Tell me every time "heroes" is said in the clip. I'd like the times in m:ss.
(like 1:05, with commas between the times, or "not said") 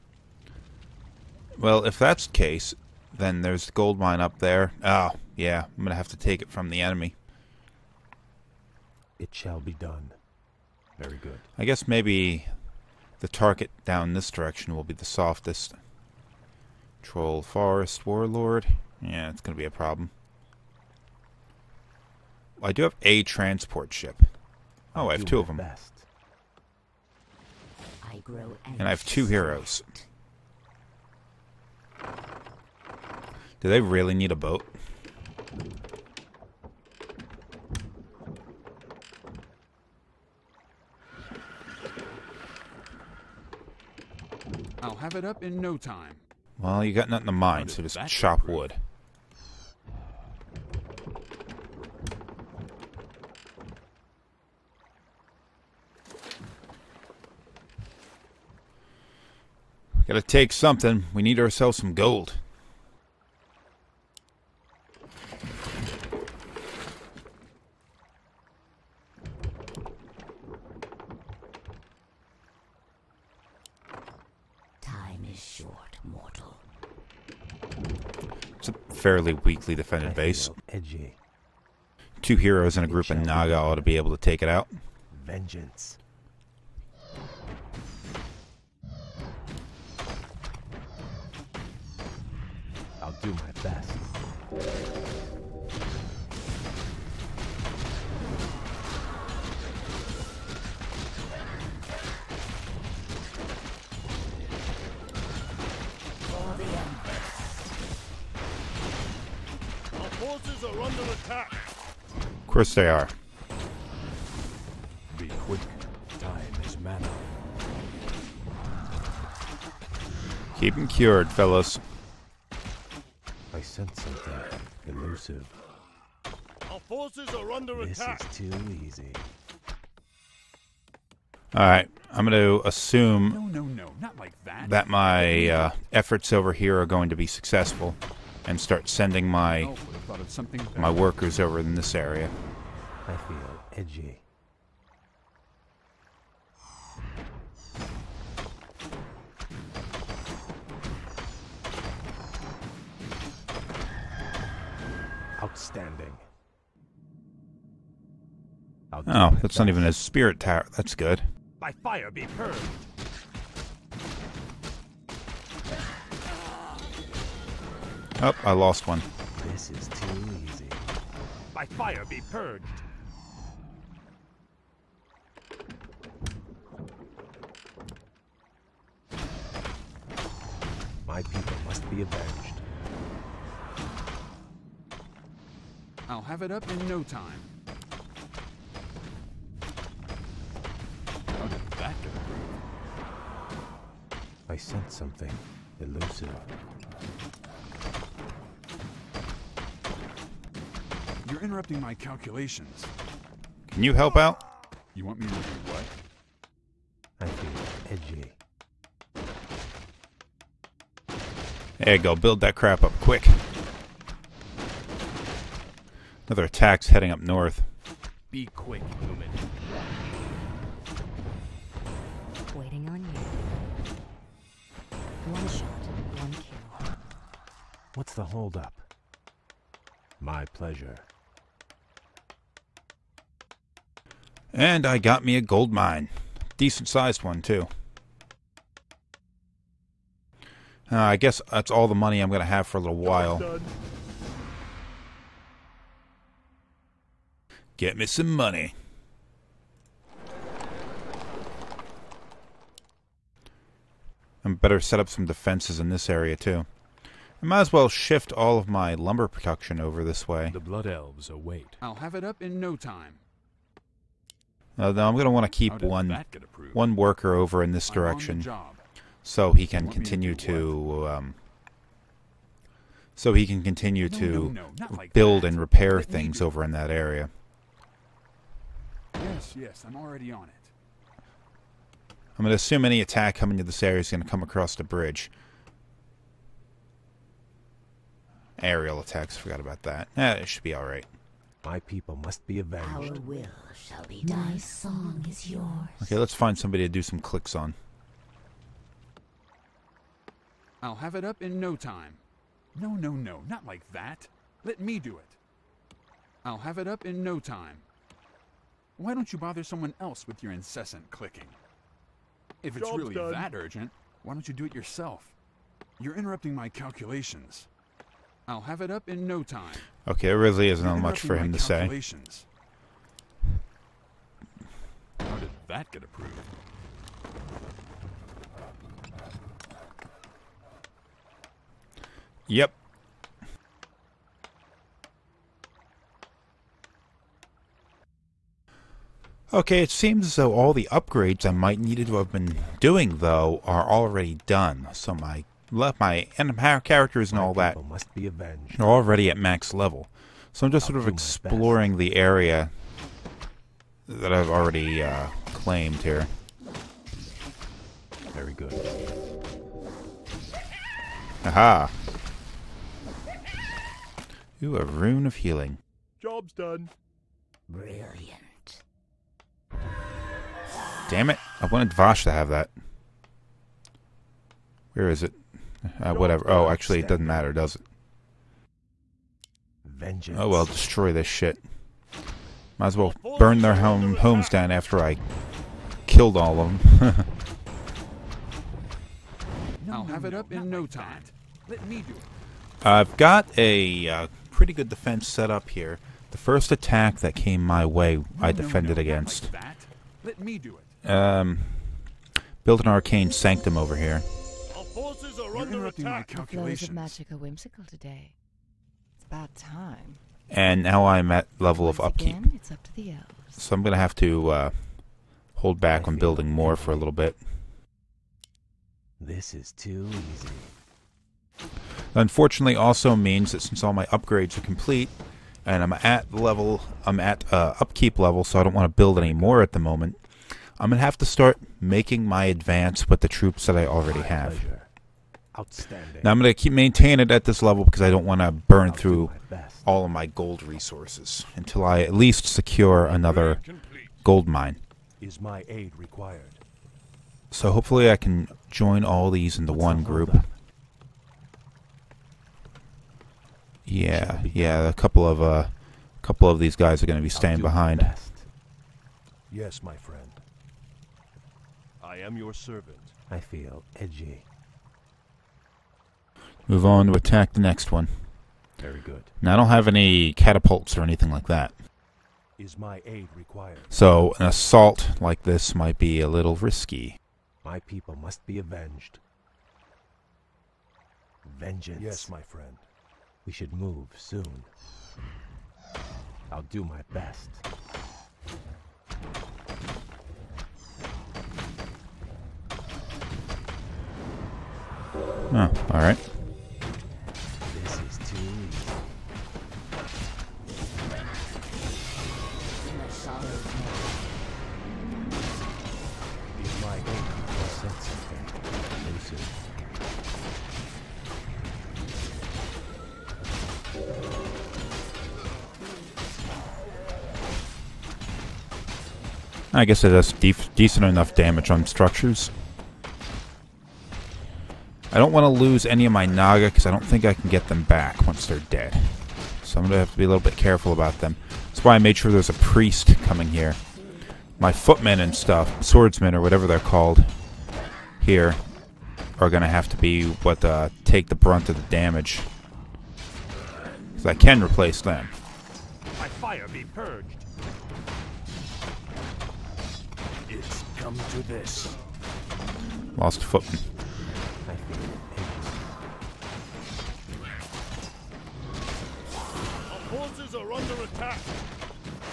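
0:29, 1:22.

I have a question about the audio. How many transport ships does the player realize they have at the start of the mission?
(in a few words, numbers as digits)
2.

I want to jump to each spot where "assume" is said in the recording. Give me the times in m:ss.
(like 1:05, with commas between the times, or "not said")
2:12, 4:42.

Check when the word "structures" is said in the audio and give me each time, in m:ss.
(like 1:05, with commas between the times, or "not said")
8:41.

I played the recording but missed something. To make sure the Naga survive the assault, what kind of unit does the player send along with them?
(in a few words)
priest.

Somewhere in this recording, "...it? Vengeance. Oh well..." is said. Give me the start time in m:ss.
6:17.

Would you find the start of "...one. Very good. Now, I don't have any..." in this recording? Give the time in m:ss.
7:47.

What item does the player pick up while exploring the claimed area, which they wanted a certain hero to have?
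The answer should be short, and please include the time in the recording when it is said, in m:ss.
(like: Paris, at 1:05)
rune of healing, at 6:04.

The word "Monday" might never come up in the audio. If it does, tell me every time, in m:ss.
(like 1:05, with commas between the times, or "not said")
not said.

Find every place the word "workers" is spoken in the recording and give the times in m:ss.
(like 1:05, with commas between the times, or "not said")
2:20, 4:26.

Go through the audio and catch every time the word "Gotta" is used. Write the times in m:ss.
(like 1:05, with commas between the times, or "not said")
1:00.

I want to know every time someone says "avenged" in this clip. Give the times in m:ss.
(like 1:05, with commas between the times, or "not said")
3:02, 4:52, 7:58.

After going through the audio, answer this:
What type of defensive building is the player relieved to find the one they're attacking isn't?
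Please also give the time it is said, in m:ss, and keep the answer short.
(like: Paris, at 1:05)
spirit tower, at 2:39.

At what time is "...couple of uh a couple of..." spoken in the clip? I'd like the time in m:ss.
7:34.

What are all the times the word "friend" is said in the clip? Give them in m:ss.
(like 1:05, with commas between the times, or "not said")
7:39, 8:02.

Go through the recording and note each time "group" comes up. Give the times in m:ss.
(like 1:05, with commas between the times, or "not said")
1:22, 7:30.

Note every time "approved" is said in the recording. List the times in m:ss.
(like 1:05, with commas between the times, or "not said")
5:26.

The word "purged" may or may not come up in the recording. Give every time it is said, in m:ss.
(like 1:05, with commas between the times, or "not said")
2:42, 2:52, 9:06.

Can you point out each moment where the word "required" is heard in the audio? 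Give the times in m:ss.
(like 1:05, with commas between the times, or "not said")
7:25, 7:53.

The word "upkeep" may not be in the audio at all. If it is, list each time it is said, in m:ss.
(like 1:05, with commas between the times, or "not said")
6:52, 7:07.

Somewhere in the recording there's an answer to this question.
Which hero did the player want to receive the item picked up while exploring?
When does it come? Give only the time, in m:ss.
6:11.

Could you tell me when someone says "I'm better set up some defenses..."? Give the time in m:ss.
4:14.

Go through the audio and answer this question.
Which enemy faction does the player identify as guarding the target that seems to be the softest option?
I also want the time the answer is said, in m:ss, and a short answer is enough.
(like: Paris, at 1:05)
Troll Forest Warlord, at 0:17.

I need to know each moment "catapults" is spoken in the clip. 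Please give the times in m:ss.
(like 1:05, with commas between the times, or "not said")
7:50.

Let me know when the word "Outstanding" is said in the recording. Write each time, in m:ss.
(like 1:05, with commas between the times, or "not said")
2:35, 7:15.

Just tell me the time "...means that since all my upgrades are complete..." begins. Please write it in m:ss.
7:03.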